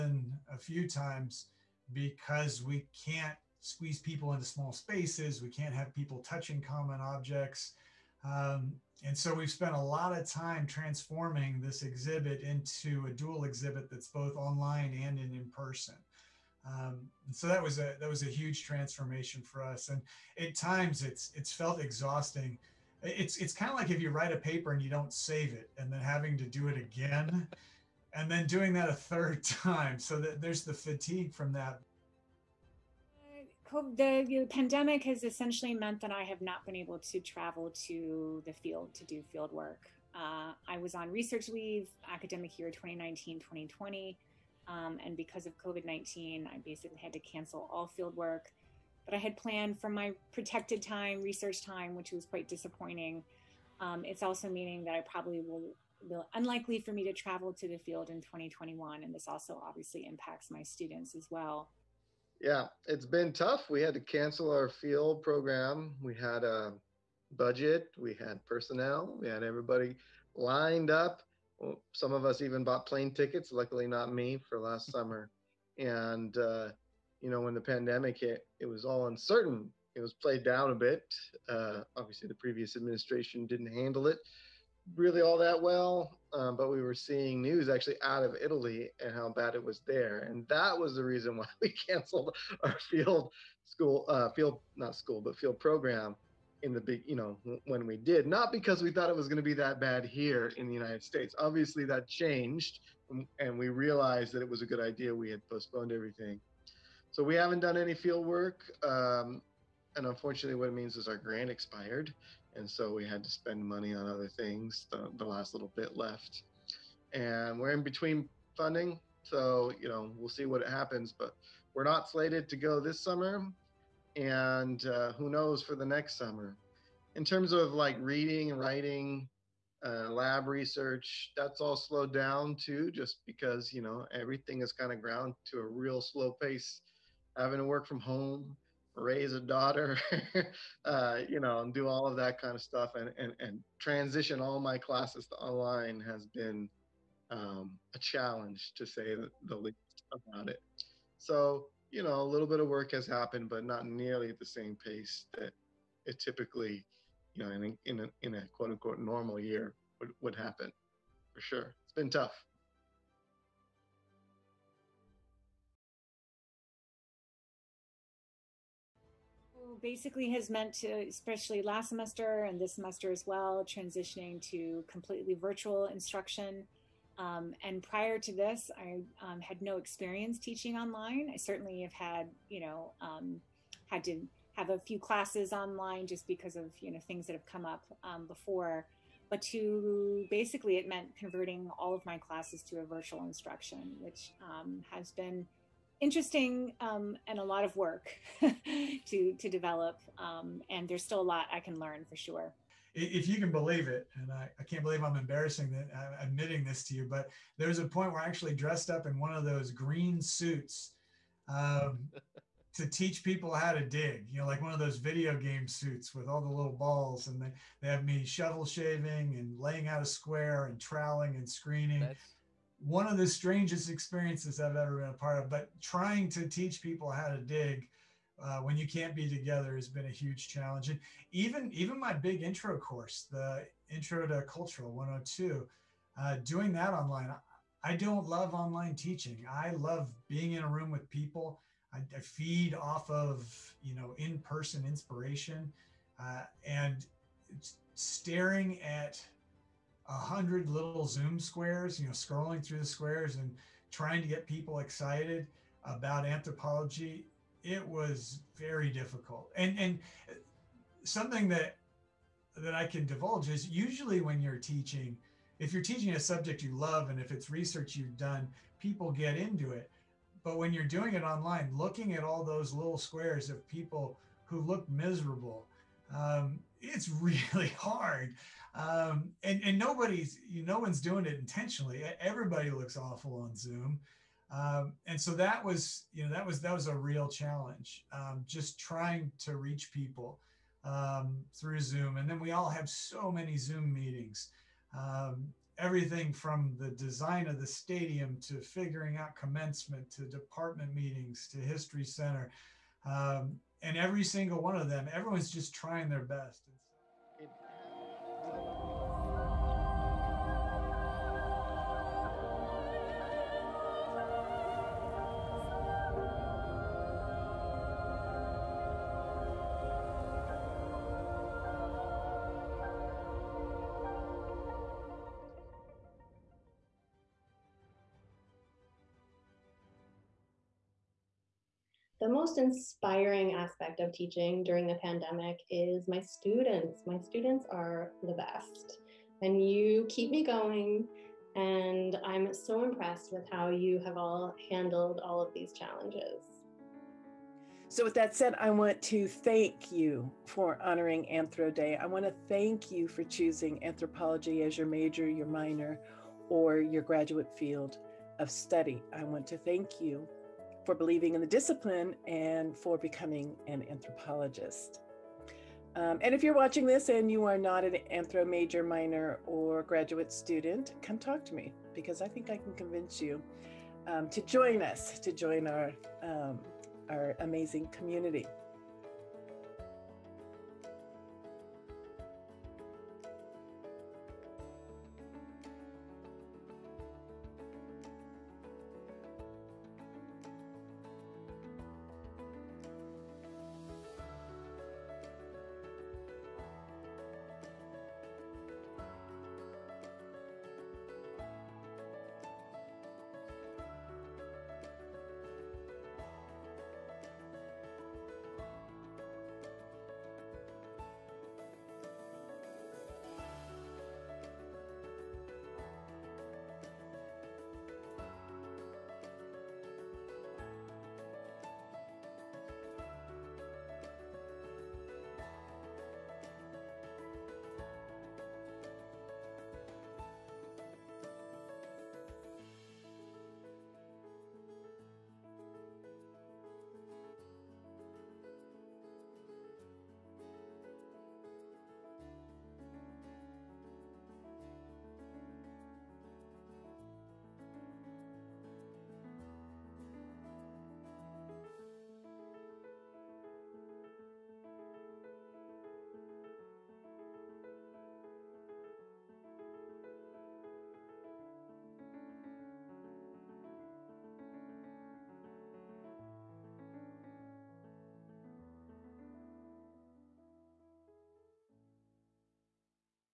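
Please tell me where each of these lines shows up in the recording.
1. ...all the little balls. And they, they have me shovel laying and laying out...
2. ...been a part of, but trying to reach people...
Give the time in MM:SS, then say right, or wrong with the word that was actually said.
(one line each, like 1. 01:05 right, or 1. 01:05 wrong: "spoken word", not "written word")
1. 03:36 wrong: "shaving", not "laying"
2. 03:44 wrong: "teach", not "reach".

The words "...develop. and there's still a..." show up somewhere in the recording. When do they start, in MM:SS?
03:19.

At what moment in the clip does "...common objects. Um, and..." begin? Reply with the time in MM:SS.
00:06.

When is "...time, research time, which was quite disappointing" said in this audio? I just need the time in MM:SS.
00:50.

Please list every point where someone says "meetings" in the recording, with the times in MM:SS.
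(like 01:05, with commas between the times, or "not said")
04:53, 05:00.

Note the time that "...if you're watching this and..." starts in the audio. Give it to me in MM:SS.
06:06.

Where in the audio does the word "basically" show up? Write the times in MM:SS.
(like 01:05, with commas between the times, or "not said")
00:46, 02:49, 03:10.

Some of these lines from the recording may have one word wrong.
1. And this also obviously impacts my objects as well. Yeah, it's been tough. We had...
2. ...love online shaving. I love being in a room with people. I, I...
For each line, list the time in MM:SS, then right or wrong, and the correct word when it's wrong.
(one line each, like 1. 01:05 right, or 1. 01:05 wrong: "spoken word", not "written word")
1. 00:59 wrong: "students", not "objects"
2. 03:58 wrong: "teaching", not "shaving".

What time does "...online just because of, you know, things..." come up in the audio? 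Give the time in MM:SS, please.
03:05.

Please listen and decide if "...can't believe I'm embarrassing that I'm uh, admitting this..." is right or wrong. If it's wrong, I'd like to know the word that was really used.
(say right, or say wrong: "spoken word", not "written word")
right.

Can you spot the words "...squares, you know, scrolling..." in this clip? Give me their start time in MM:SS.
04:11.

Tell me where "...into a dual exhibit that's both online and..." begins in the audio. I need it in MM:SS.
00:12.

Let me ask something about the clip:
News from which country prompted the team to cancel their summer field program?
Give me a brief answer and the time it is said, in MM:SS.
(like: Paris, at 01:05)
Italy, at 01:28.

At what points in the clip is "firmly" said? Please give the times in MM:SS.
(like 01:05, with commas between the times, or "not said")
not said.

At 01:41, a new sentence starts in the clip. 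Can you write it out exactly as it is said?
Obviously, that changed, and we realized that it was a good idea.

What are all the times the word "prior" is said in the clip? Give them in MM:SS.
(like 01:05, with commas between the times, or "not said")
02:57.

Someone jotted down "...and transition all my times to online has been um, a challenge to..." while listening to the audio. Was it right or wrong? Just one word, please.
wrong.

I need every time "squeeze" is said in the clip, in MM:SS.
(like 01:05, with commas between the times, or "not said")
00:03.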